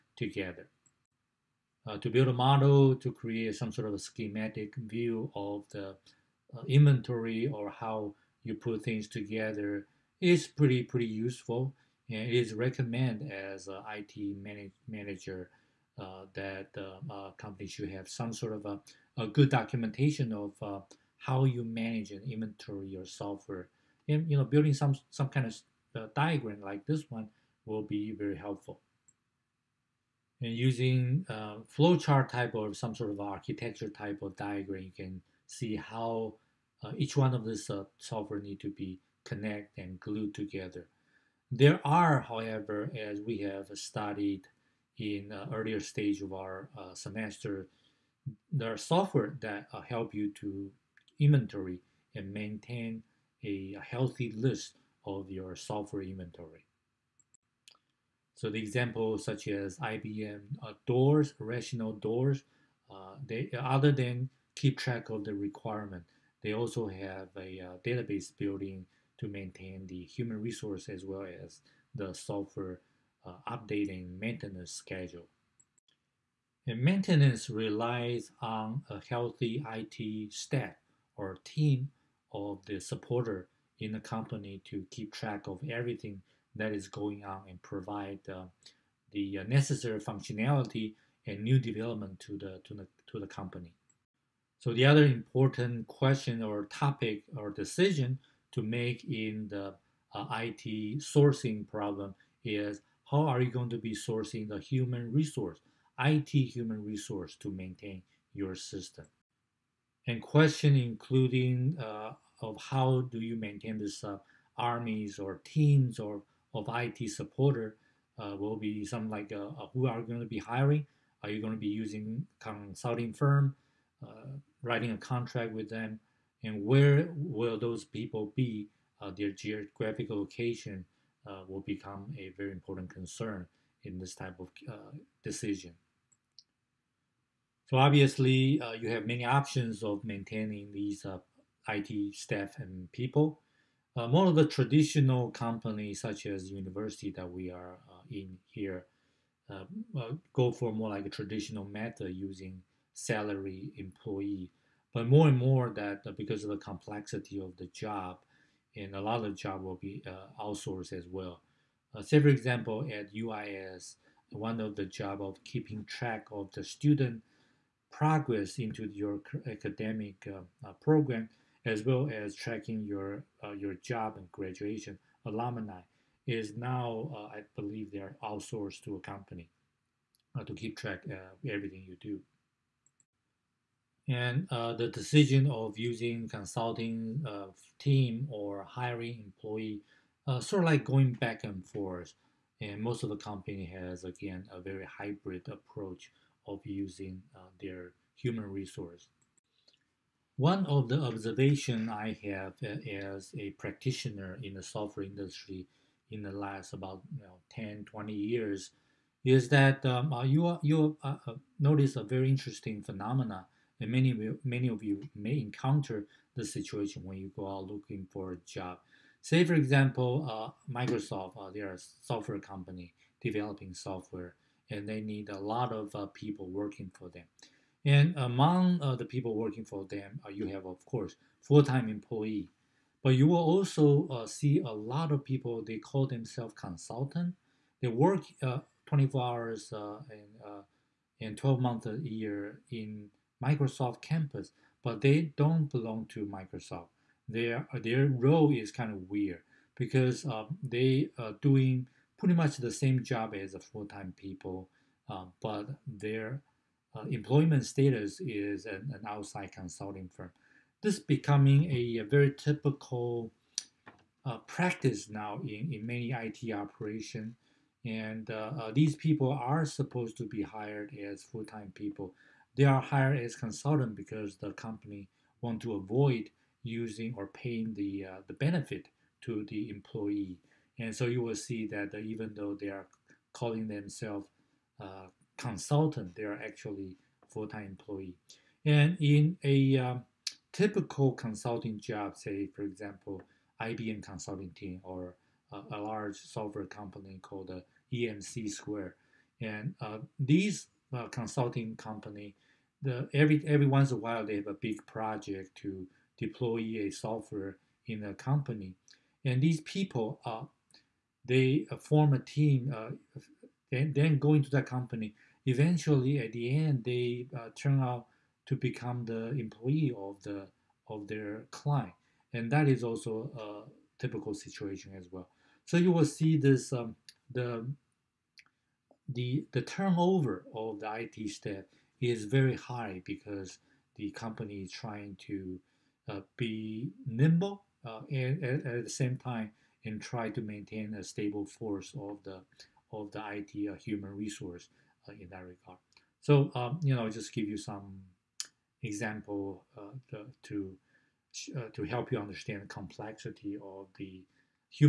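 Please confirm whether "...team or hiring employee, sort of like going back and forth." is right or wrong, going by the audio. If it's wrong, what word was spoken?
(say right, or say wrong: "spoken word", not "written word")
right.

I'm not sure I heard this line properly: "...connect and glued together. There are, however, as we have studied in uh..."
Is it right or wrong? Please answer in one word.
right.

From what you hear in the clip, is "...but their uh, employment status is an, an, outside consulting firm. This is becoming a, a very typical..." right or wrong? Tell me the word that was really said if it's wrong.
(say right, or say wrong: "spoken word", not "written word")
right.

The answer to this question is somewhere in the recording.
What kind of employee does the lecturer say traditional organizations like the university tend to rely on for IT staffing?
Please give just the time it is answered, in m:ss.
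2:32.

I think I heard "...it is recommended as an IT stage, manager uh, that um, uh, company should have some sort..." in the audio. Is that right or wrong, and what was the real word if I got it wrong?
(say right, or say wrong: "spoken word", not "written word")
wrong: "manage", not "stage".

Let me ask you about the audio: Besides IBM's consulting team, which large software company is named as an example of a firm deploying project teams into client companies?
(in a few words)
EMC Square.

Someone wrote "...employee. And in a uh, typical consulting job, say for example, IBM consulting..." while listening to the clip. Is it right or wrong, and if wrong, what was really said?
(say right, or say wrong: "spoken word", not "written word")
right.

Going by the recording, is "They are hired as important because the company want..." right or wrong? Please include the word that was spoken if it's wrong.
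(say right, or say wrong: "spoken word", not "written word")
wrong: "consultant", not "important".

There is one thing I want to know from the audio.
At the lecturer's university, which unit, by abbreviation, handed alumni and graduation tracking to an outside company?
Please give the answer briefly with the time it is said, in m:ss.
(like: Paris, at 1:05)
UIS, at 2:43.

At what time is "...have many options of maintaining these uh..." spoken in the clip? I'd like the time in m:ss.
2:18.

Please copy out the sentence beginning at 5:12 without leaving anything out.
Uh, then, then go into that company.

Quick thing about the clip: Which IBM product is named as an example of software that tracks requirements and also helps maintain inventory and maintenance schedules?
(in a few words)
Rational DOORS.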